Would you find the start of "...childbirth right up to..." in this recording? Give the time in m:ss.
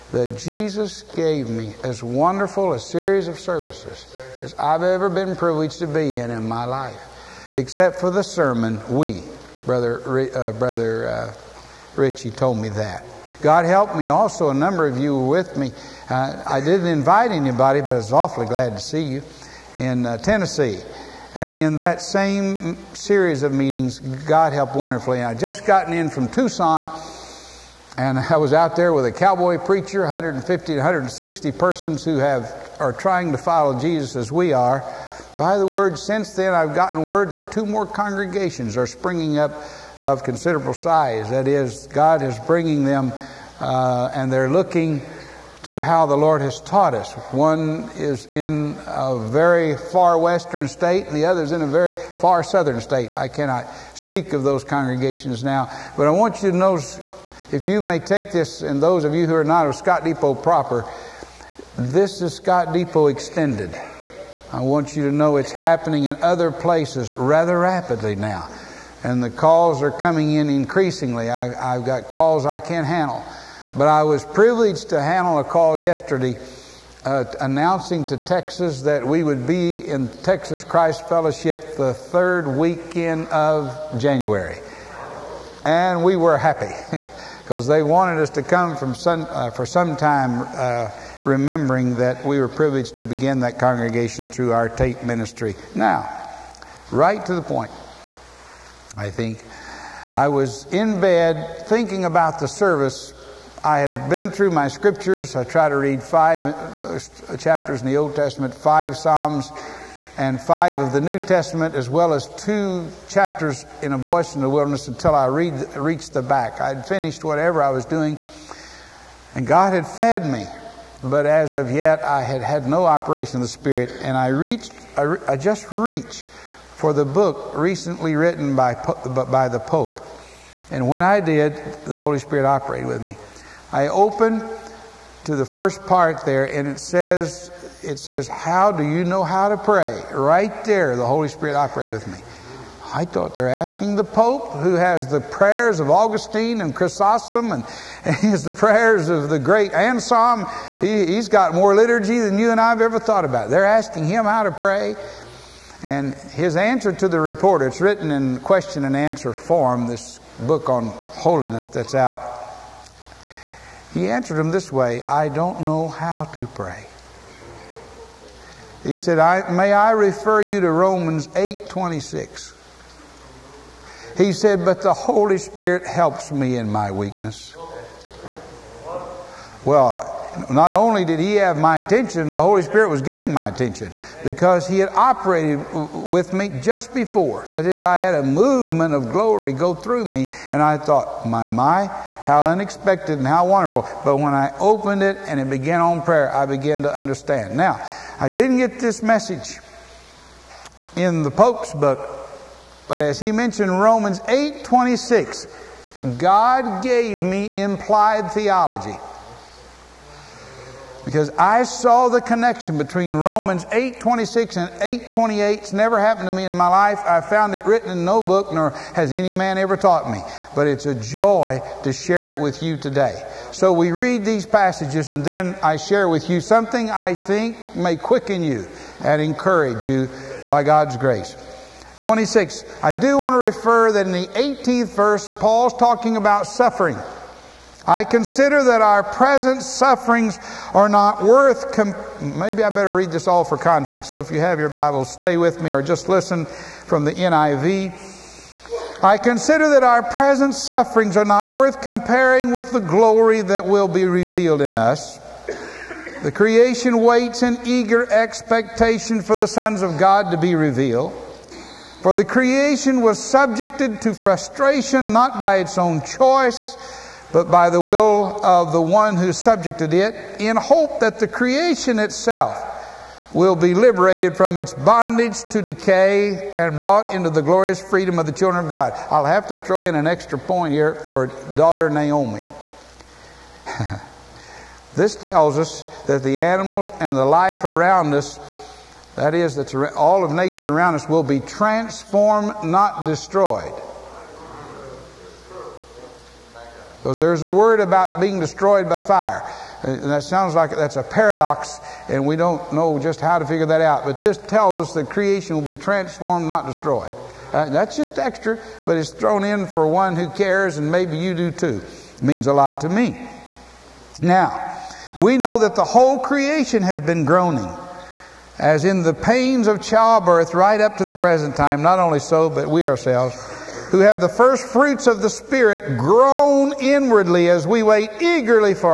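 5:19.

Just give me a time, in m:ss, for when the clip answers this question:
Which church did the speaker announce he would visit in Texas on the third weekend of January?
1:20.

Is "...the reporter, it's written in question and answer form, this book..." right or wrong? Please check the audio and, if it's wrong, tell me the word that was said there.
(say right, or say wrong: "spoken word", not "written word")
right.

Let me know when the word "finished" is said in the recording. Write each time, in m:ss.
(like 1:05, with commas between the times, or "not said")
1:56.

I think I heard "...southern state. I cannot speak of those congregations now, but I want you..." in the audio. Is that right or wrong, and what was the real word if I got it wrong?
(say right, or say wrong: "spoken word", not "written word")
right.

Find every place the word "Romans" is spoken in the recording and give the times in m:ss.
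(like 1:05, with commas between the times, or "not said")
2:50, 3:23, 3:33.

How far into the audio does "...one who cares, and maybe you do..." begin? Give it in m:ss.
5:09.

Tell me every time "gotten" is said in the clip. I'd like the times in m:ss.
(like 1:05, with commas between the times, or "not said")
0:25, 0:36.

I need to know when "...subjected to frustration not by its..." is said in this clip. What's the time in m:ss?
4:23.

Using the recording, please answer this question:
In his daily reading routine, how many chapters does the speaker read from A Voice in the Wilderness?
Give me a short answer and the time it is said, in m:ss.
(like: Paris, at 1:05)
2, at 1:52.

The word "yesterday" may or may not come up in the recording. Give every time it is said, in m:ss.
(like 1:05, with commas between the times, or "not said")
1:15.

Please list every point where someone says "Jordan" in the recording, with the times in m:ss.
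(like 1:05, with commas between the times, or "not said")
not said.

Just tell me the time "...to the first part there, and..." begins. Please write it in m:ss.
2:15.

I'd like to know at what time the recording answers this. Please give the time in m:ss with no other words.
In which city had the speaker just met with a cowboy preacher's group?
0:26.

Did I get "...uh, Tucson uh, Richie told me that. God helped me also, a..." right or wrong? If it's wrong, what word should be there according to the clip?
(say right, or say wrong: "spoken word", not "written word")
wrong: "Brother", not "Tucson".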